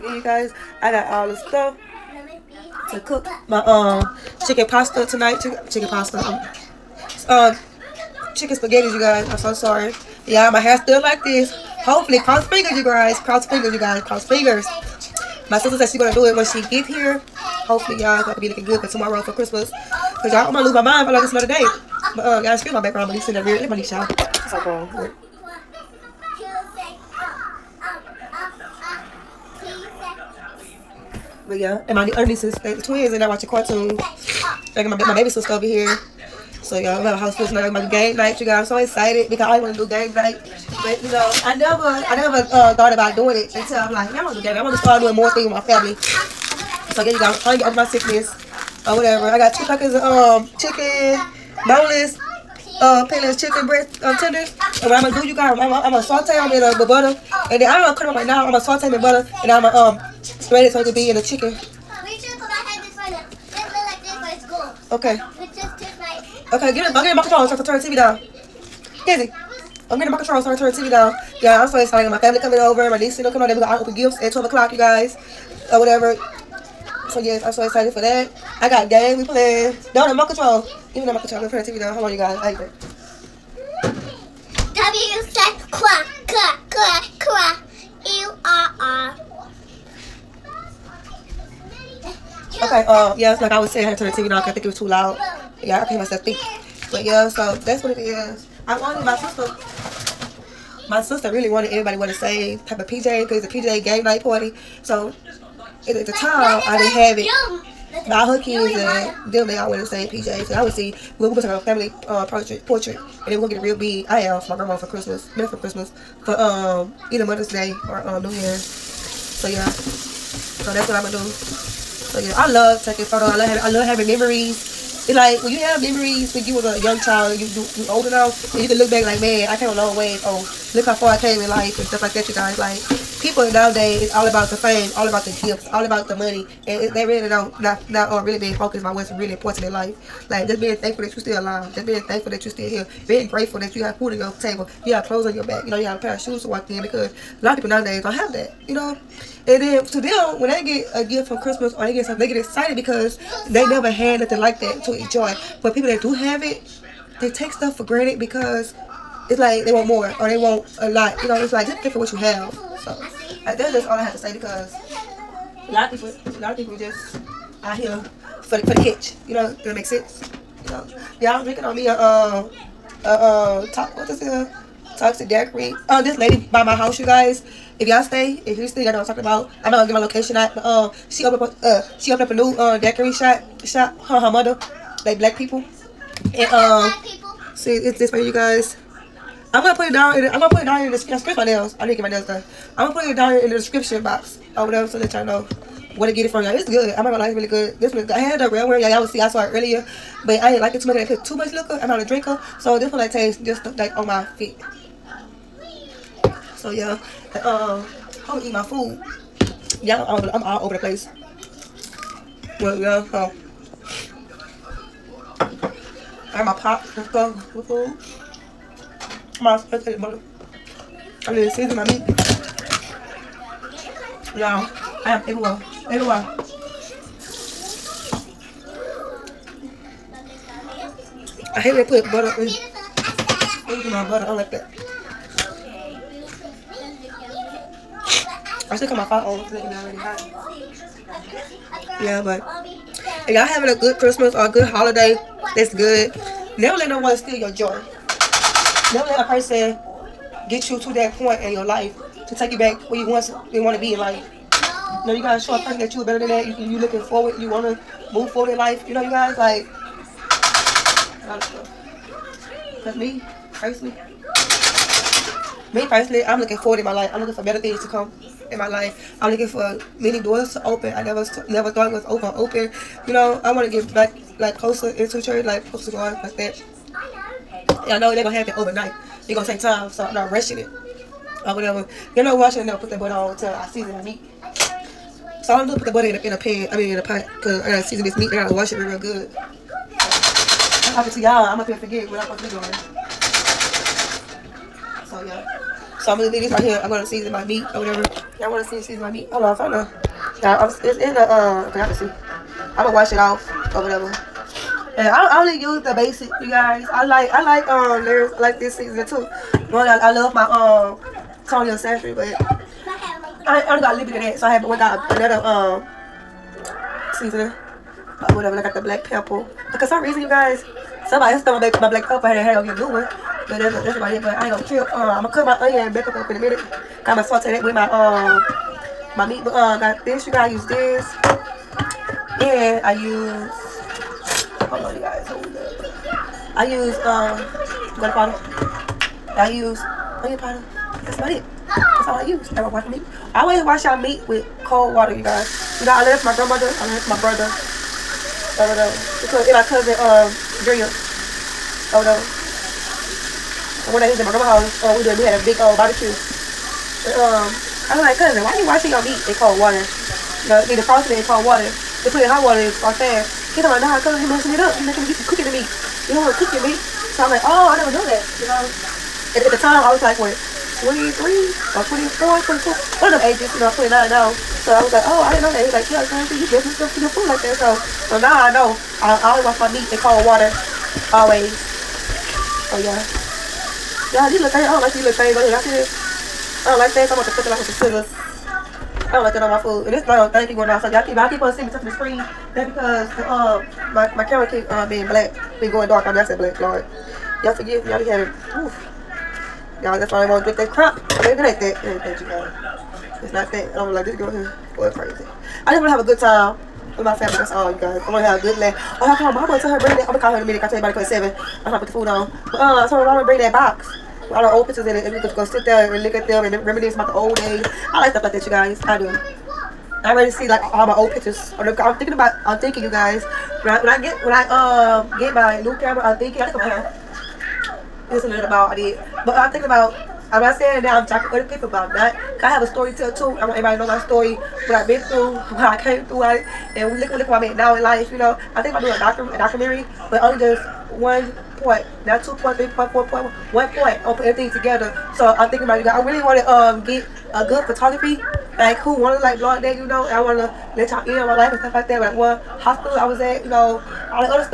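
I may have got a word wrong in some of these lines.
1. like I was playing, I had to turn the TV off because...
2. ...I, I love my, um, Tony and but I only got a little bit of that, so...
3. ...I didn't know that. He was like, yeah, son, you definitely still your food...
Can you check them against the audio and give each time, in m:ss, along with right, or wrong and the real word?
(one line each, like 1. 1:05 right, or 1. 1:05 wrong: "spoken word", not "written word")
1. 1:33 wrong: "saying", not "playing"
2. 5:09 right
3. 6:15 right.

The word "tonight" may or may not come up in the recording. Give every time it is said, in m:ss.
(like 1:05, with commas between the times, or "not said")
0:05, 0:37.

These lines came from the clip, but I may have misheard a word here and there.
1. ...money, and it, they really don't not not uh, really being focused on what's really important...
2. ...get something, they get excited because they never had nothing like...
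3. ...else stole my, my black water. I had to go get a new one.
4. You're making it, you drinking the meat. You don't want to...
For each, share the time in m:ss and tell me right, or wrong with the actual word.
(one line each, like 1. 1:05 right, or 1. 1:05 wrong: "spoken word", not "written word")
1. 2:16 right
2. 2:31 right
3. 5:21 wrong: "pepper", not "water"
4. 6:04 wrong: "cooking", not "drinking".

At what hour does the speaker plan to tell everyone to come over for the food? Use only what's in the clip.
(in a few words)
7.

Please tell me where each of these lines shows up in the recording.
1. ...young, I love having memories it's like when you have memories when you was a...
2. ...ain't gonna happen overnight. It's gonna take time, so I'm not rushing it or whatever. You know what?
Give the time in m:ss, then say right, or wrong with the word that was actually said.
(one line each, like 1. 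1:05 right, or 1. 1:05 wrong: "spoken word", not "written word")
1. 2:03 wrong: "having", not "young"
2. 4:38 right.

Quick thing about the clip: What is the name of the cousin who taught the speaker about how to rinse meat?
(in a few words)
Drea.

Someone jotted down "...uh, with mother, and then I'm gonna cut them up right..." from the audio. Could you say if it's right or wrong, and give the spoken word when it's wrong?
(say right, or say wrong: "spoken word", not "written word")
wrong: "butter", not "mother".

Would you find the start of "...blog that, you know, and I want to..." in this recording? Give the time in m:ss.
7:29.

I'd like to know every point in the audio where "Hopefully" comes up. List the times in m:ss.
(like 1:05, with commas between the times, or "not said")
0:11, 0:17.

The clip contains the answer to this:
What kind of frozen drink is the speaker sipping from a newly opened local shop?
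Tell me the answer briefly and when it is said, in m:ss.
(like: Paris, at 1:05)
Toxic daiquiri, at 2:54.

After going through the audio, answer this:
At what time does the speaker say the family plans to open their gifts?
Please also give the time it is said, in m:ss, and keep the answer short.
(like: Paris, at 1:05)
12 o'clock, at 1:14.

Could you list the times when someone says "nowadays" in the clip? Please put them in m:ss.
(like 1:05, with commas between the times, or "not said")
2:13, 2:27.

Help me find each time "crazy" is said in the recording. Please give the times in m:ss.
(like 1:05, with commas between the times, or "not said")
6:44.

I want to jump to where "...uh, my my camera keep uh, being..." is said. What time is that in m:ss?
6:33.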